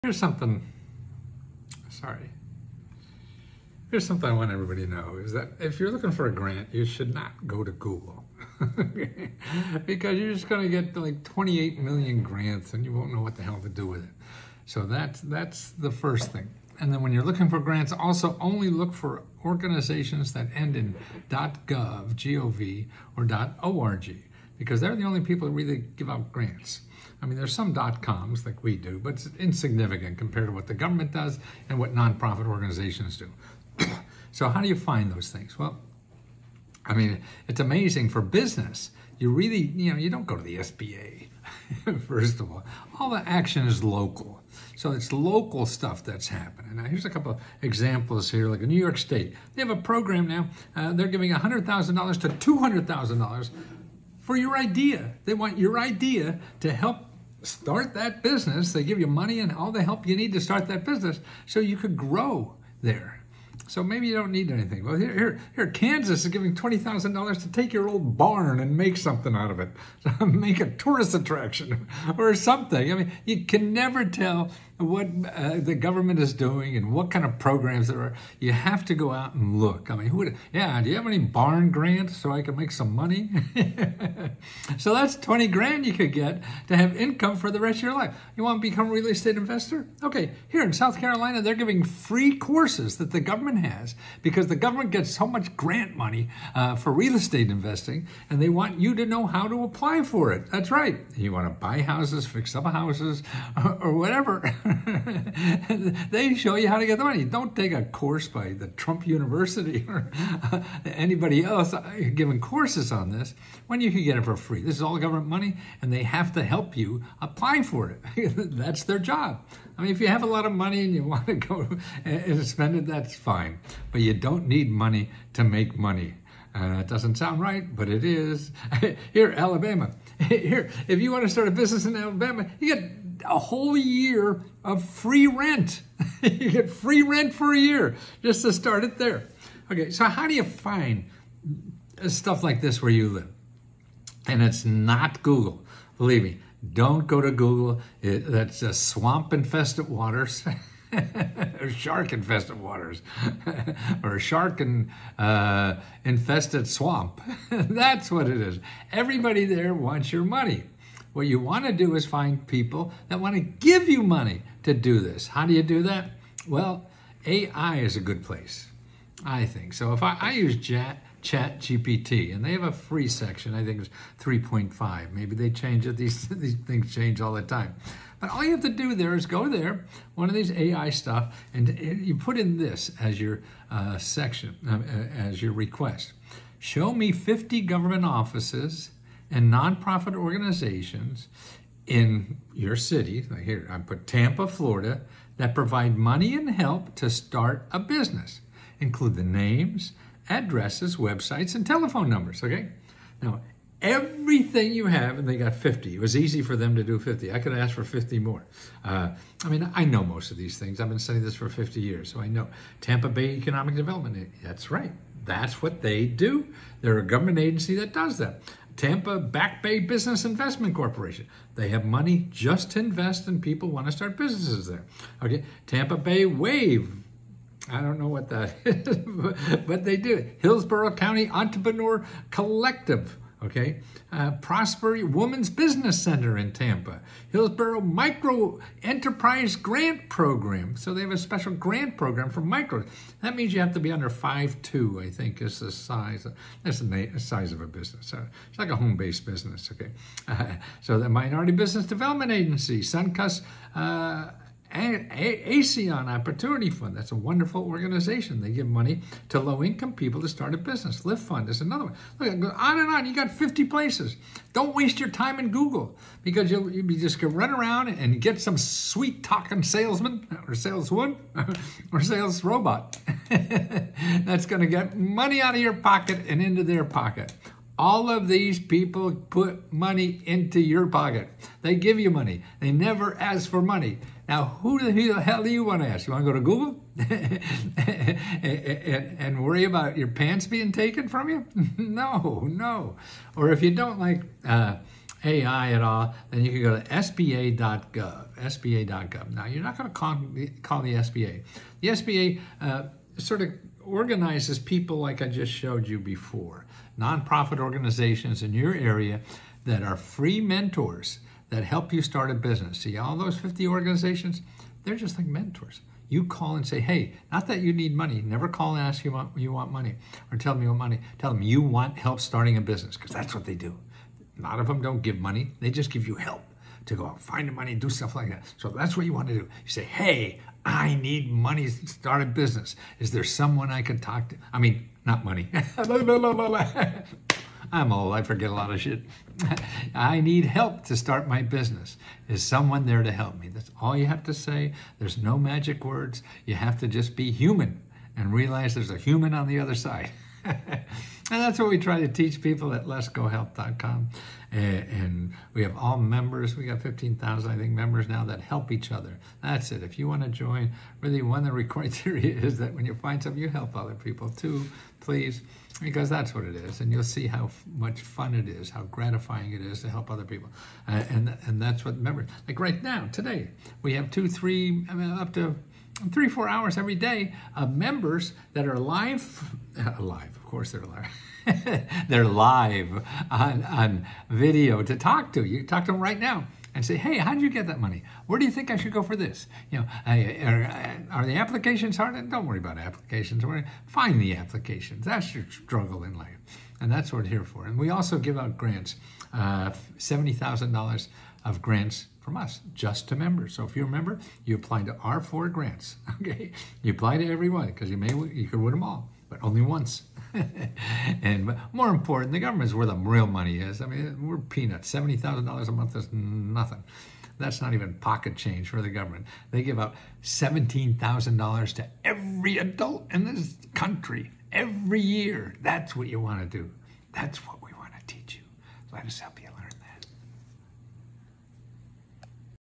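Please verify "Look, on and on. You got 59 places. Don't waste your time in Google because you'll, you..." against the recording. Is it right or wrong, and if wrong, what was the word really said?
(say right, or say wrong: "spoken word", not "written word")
wrong: "50", not "59".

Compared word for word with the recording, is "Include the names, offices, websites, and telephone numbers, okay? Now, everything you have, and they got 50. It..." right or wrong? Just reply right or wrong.
wrong.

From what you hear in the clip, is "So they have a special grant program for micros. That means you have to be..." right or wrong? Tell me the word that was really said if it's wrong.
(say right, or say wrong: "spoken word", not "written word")
right.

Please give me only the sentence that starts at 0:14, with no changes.
So that's, that's the first thing.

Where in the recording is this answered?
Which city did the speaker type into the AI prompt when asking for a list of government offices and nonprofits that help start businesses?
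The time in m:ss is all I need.
3:14.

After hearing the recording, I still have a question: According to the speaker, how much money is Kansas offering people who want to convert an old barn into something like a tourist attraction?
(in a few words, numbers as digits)
$20,000.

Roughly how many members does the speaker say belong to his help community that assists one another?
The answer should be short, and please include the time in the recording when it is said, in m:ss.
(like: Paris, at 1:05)
15,000, at 5:56.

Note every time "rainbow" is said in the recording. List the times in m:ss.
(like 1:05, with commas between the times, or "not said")
not said.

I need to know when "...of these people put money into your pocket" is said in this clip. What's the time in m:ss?
4:38.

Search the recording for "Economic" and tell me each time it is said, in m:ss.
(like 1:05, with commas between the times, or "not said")
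3:33.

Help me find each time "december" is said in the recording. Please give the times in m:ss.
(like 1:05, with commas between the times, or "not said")
not said.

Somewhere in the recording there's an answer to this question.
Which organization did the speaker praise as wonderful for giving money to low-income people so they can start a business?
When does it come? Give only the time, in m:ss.
4:14.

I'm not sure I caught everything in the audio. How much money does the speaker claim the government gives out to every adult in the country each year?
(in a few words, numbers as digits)
$17,000.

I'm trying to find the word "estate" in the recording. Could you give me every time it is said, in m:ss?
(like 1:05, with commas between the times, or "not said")
1:29, 1:37.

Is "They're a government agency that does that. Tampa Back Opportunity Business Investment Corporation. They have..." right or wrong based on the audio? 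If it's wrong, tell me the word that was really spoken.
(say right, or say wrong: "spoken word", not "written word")
wrong: "Bay", not "Opportunity".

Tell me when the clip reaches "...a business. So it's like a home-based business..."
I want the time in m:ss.
4:07.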